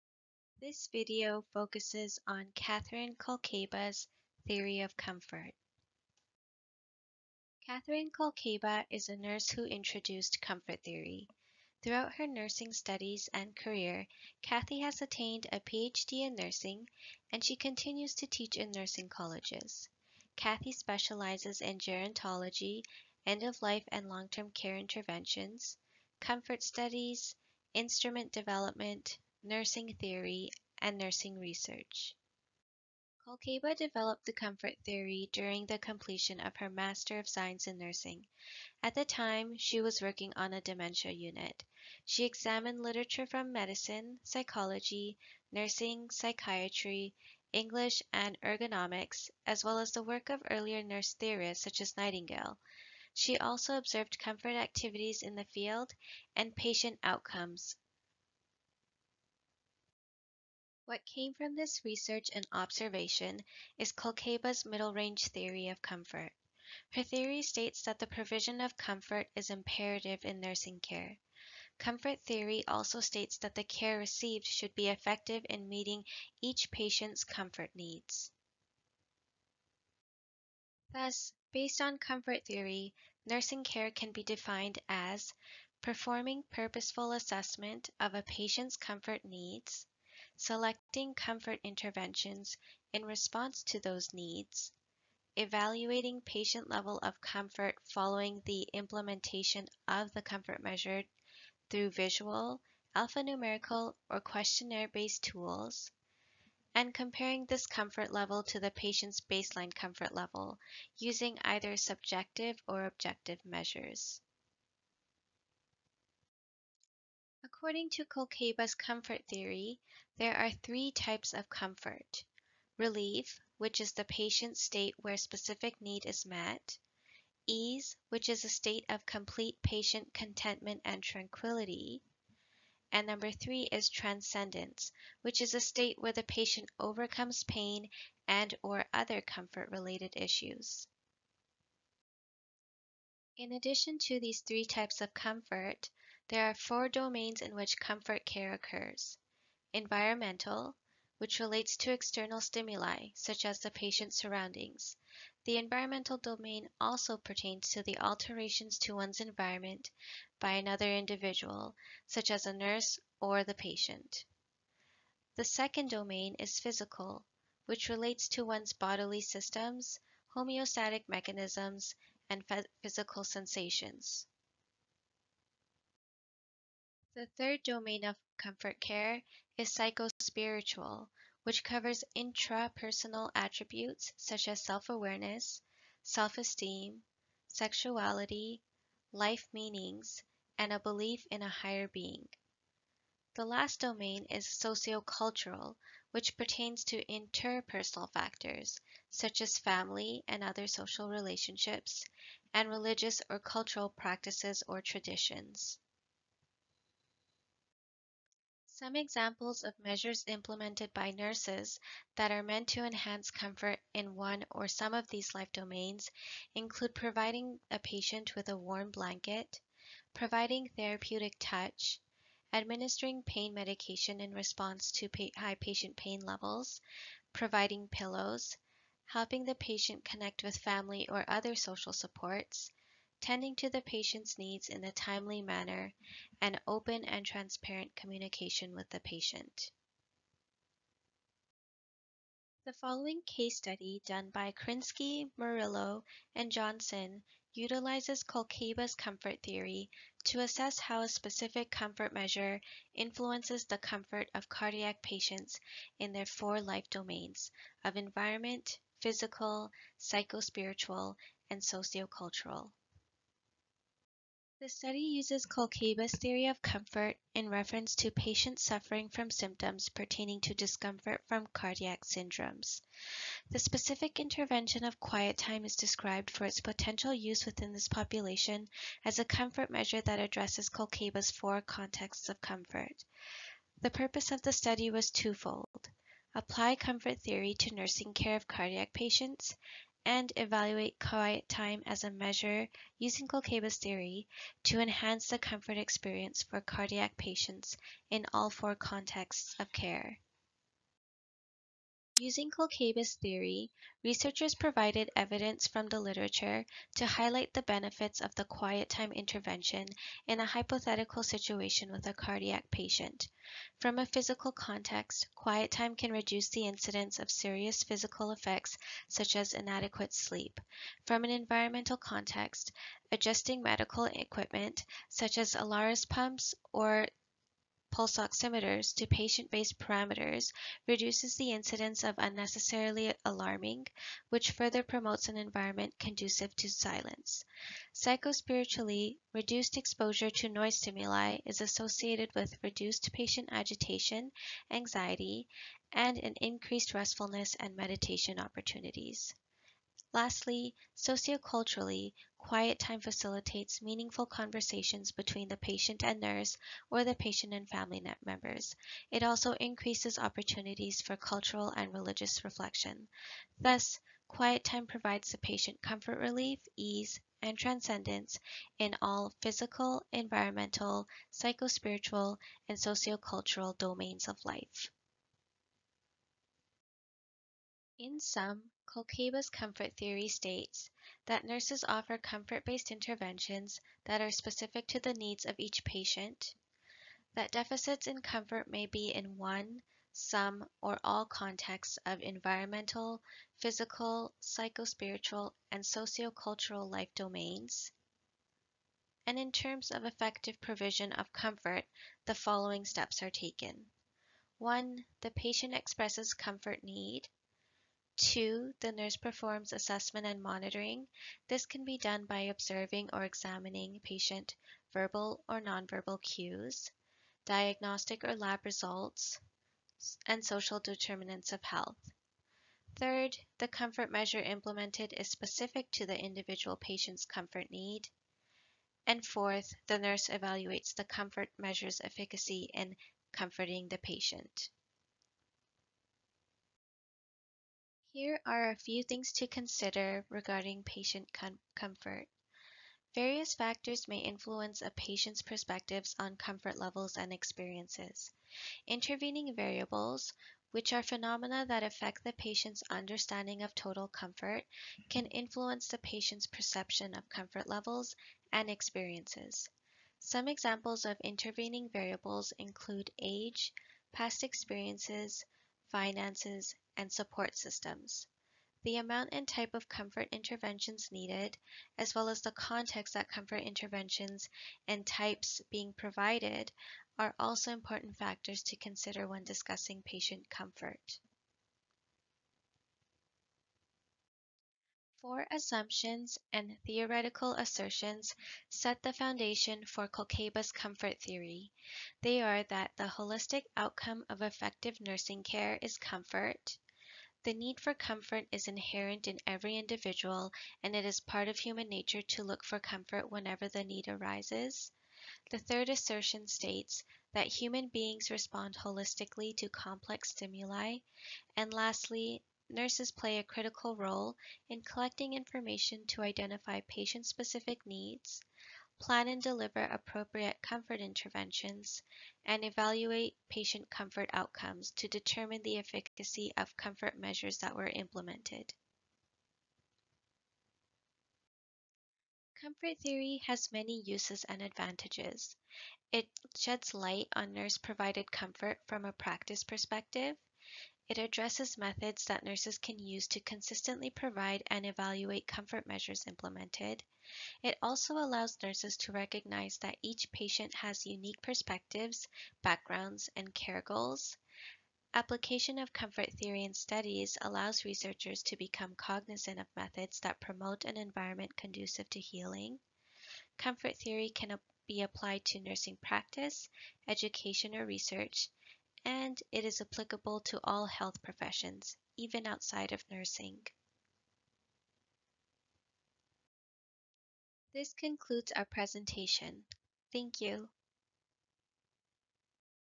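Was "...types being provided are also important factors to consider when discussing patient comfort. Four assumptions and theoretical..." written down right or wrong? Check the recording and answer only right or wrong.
right.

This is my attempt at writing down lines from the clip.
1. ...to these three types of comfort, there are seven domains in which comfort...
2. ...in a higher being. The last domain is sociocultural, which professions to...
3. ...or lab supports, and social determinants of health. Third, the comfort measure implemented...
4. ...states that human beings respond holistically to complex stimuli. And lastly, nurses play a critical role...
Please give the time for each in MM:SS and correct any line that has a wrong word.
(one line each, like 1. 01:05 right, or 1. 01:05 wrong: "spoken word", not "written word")
1. 02:23 wrong: "four", not "seven"
2. 03:11 wrong: "pertains", not "professions"
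3. 06:58 wrong: "results", not "supports"
4. 08:26 right.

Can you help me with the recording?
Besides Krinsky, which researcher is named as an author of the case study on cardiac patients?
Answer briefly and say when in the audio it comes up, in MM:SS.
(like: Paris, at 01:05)
Murillo, at 04:05.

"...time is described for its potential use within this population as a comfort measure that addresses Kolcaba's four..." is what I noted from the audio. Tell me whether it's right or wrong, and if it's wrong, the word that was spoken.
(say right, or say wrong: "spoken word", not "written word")
right.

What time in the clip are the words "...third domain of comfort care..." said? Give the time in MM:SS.
02:57.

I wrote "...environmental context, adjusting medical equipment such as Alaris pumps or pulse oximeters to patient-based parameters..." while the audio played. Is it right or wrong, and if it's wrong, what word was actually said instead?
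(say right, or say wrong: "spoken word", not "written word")
right.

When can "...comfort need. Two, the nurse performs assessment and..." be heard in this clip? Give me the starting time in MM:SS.
06:46.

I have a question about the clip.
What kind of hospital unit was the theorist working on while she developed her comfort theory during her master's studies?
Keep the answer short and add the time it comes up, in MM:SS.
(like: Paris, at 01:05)
Dementia unit, at 00:40.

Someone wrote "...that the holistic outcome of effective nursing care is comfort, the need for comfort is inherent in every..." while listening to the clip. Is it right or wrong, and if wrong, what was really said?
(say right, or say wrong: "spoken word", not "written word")
right.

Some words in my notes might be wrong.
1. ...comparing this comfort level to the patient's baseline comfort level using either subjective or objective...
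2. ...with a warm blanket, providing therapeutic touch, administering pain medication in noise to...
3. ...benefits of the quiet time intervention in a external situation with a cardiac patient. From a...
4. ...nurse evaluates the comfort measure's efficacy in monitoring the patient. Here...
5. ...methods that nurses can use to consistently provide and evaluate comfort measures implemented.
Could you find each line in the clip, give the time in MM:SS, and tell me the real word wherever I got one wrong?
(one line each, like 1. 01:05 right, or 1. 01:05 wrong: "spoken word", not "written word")
1. 01:46 right
2. 03:38 wrong: "response", not "noise"
3. 05:07 wrong: "hypothetical", not "external"
4. 07:09 wrong: "comforting", not "monitoring"
5. 09:01 right.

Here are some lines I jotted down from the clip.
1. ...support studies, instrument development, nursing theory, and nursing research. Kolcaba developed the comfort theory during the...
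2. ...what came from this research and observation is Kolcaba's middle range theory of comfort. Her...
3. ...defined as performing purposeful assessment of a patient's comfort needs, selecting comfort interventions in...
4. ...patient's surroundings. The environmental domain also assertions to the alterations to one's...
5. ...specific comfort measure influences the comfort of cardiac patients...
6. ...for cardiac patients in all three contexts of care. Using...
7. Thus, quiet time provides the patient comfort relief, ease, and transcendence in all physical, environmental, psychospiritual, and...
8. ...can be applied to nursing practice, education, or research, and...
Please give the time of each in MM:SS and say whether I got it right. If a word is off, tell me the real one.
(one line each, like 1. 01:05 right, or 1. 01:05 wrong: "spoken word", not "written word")
1. 00:26 wrong: "comfort", not "support"
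2. 01:00 right
3. 01:24 right
4. 02:33 wrong: "pertains", not "assertions"
5. 04:11 right
6. 04:56 wrong: "four", not "three"
7. 06:03 right
8. 09:24 right.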